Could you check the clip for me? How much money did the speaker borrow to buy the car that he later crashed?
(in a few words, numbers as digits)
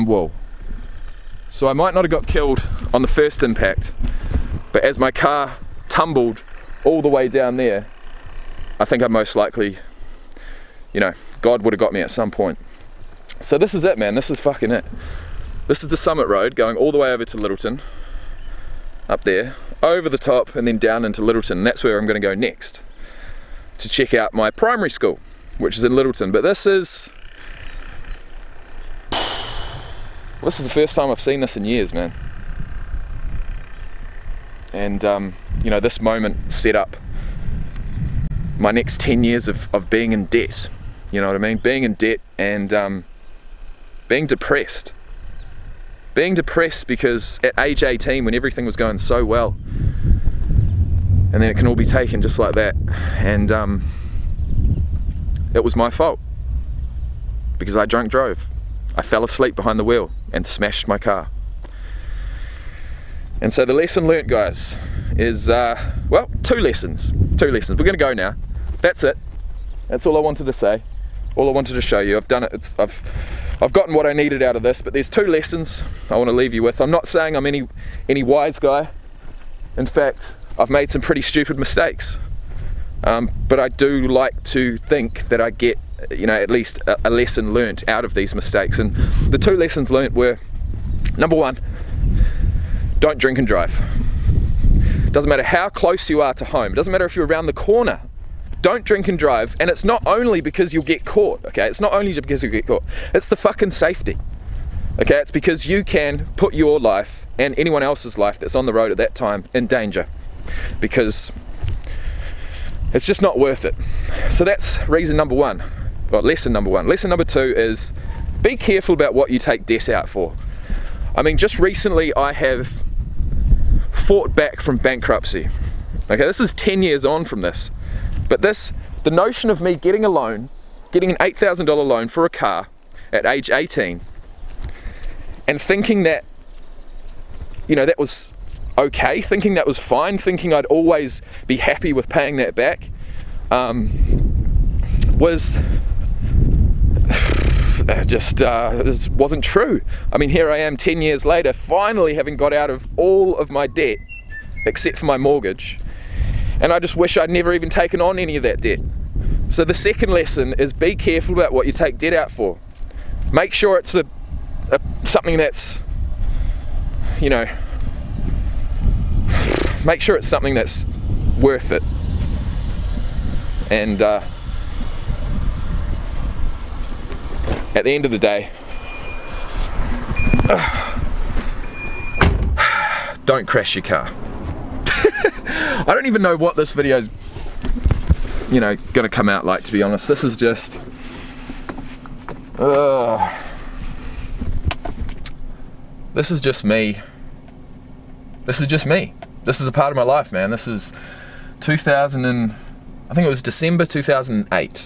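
$8,000.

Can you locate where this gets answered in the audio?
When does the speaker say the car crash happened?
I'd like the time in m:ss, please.
3:23.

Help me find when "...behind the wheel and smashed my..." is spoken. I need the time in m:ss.
0:59.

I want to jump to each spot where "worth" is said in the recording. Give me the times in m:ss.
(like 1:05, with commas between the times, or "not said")
1:53, 2:51.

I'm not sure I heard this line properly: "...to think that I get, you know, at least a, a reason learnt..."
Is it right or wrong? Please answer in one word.
wrong.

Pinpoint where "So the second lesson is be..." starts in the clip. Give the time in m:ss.
2:39.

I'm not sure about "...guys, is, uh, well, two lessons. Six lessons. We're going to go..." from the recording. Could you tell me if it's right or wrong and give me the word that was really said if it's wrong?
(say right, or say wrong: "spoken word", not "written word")
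wrong: "Two", not "Six".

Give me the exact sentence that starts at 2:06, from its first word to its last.
Okay, this is 10 years on from this.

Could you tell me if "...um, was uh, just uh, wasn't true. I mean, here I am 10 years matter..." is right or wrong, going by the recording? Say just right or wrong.
wrong.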